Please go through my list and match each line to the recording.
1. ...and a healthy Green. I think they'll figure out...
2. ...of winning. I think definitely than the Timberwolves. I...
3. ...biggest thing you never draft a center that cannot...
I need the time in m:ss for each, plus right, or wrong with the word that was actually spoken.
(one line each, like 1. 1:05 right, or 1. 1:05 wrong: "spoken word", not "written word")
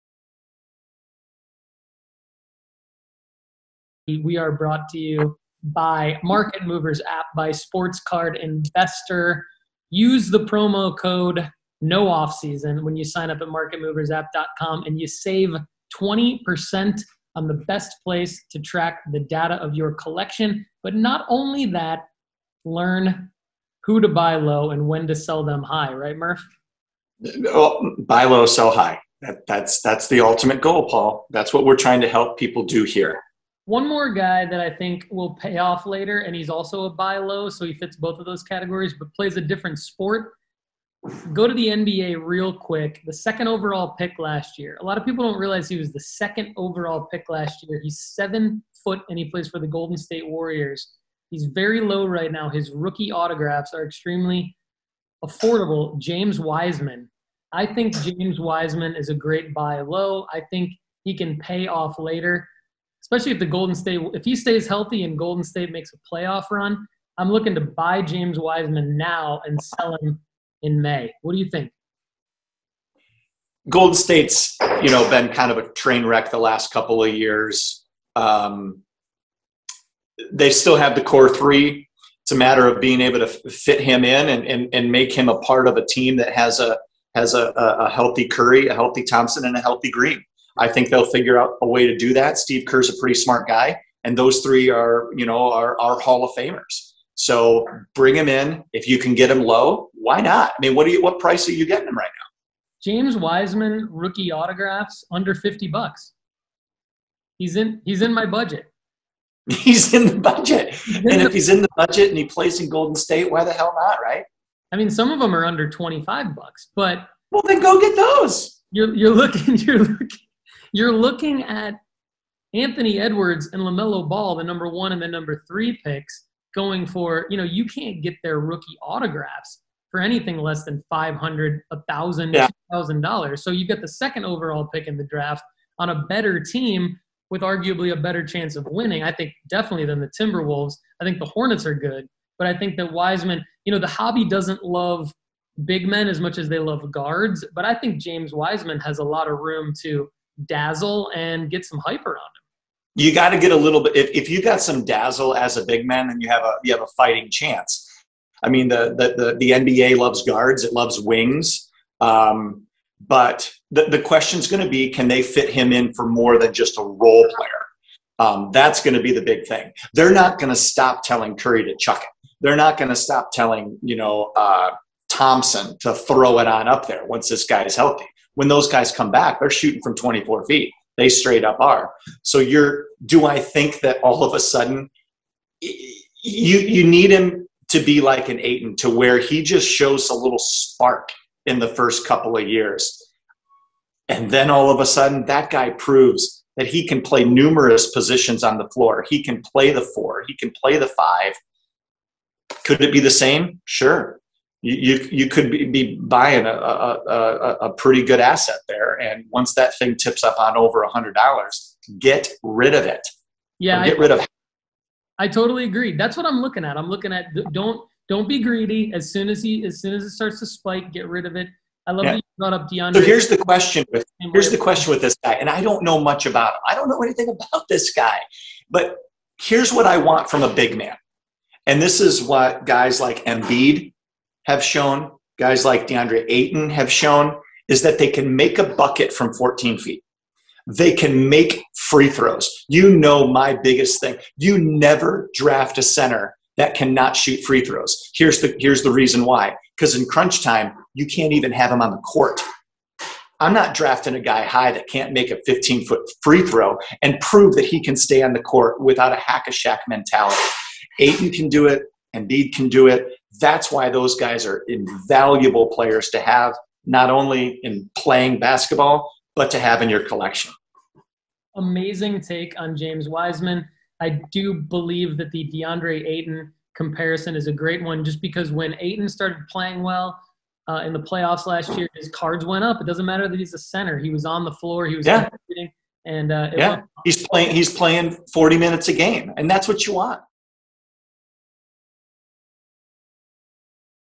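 1. 1:29 right
2. 2:18 right
3. 4:03 right.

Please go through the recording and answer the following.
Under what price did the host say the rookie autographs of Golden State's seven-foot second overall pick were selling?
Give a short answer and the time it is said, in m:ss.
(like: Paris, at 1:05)
$50, at 1:45.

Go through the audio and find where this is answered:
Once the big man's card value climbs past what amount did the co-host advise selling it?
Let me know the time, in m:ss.
3:30.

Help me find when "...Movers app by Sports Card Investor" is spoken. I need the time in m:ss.
0:06.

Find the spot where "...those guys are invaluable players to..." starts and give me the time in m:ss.
4:23.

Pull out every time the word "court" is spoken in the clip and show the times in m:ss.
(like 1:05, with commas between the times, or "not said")
4:11, 4:18.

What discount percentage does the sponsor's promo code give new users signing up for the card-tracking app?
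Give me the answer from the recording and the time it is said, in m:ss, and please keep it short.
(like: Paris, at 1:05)
20%, at 0:15.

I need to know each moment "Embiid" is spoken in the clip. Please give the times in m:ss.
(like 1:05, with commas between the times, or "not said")
3:53, 4:22.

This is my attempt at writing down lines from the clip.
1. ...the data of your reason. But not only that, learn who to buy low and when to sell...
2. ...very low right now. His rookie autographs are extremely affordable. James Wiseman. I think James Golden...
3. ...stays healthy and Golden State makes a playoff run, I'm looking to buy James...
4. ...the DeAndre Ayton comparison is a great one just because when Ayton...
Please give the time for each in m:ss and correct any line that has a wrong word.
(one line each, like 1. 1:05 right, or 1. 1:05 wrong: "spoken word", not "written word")
1. 0:19 wrong: "collection", not "reason"
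2. 0:51 wrong: "Wiseman", not "Golden"
3. 1:04 right
4. 4:35 right.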